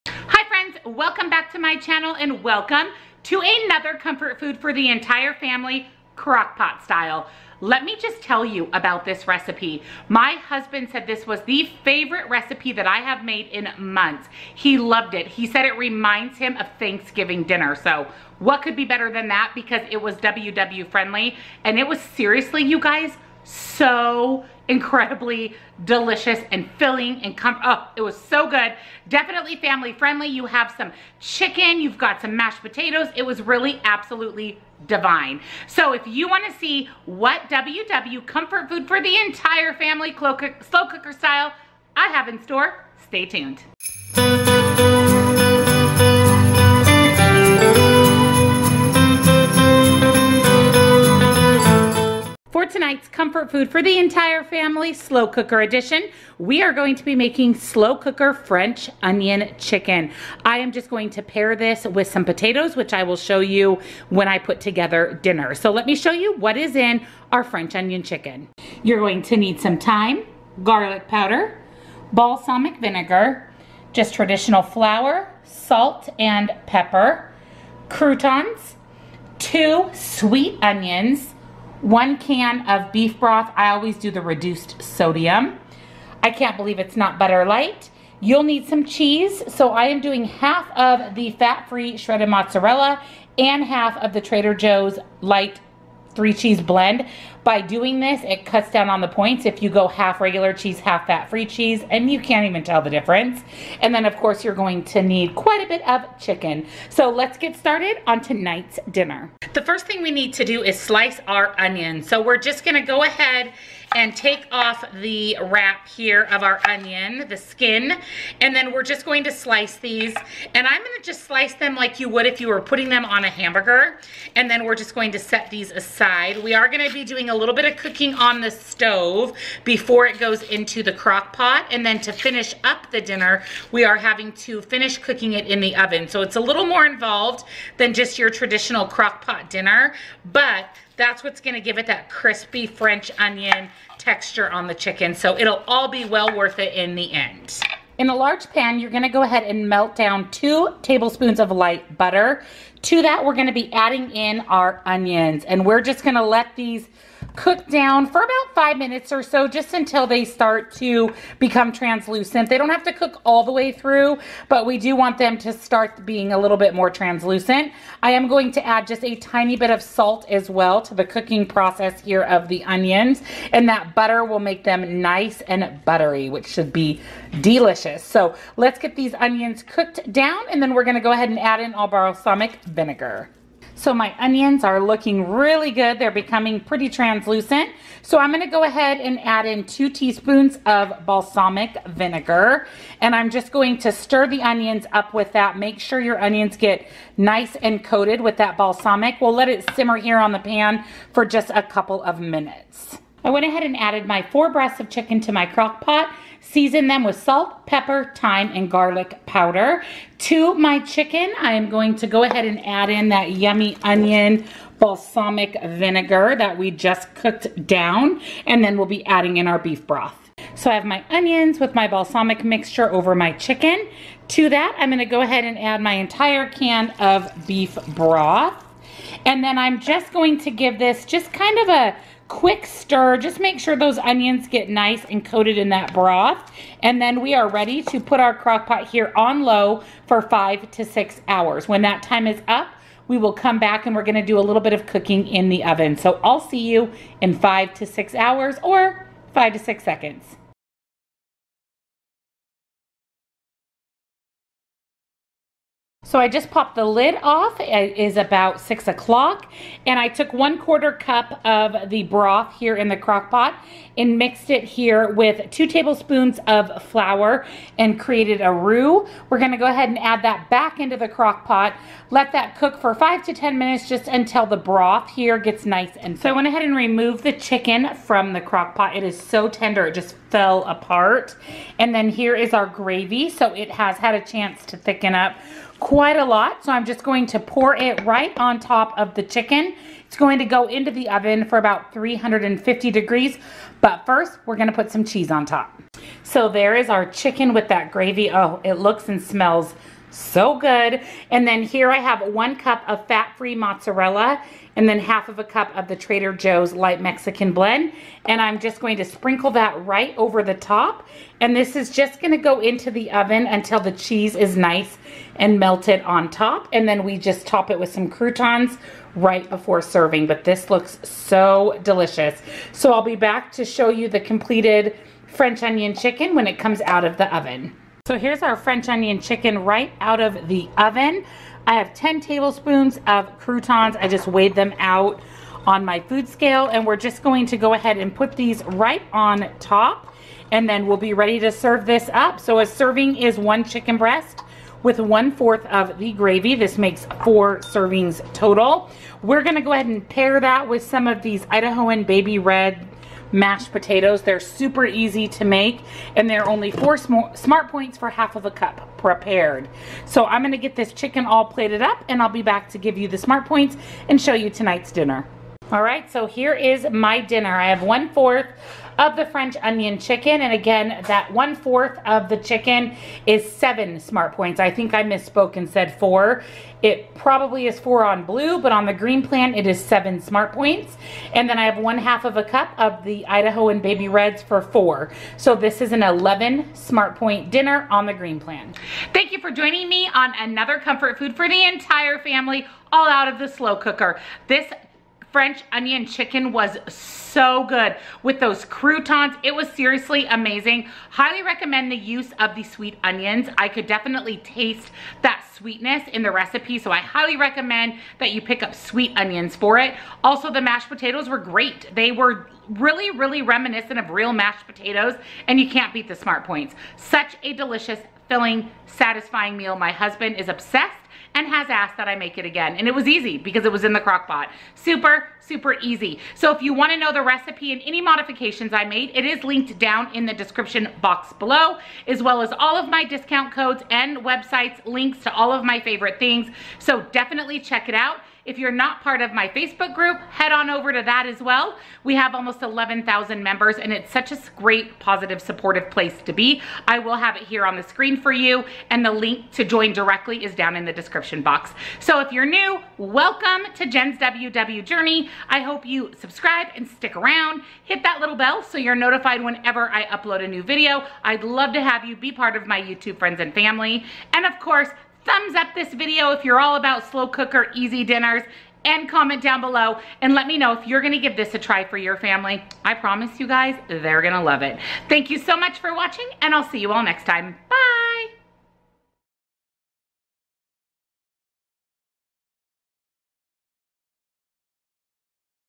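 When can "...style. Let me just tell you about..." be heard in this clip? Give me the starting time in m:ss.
0:06.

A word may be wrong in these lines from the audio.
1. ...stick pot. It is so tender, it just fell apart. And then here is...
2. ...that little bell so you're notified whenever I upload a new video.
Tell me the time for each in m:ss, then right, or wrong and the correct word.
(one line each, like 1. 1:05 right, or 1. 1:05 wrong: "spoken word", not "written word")
1. 4:38 wrong: "crock", not "stick"
2. 7:38 right.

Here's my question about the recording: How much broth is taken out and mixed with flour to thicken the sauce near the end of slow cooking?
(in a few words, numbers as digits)
1/4 cup.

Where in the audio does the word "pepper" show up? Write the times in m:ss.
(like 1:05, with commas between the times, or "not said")
1:16, 3:27.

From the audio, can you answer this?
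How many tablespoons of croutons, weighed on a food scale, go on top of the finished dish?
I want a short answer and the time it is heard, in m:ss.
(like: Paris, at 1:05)
10, at 5:31.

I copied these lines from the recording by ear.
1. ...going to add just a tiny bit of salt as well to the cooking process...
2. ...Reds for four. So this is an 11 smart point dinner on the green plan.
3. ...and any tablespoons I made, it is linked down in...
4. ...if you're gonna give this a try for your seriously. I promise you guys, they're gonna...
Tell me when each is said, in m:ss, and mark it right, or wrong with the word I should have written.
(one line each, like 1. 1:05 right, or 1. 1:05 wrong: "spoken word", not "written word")
1. 2:48 right
2. 6:24 right
3. 7:07 wrong: "modifications", not "tablespoons"
4. 7:50 wrong: "family", not "seriously".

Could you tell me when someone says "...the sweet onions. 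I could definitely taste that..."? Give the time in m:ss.
6:42.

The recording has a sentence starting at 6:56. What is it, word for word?
Such a delicious, filling, satisfying meal.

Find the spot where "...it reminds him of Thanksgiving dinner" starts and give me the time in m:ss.
0:15.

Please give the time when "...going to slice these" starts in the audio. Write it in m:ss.
1:59.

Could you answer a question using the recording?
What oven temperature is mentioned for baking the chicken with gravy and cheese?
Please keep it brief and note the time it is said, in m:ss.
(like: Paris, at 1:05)
350 degrees, at 4:51.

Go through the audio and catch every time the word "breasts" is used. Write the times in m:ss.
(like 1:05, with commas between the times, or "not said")
3:24, 5:43.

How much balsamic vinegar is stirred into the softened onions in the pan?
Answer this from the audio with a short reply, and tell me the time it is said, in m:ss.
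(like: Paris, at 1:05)
2 teaspoons, at 3:09.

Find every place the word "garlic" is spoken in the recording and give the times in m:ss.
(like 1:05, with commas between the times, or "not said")
1:10, 3:28.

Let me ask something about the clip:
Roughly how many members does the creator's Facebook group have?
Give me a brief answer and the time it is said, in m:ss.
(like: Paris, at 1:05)
11,000, at 7:22.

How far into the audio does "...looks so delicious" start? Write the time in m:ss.
5:20.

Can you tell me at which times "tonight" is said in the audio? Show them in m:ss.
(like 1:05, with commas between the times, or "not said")
1:48, 6:04.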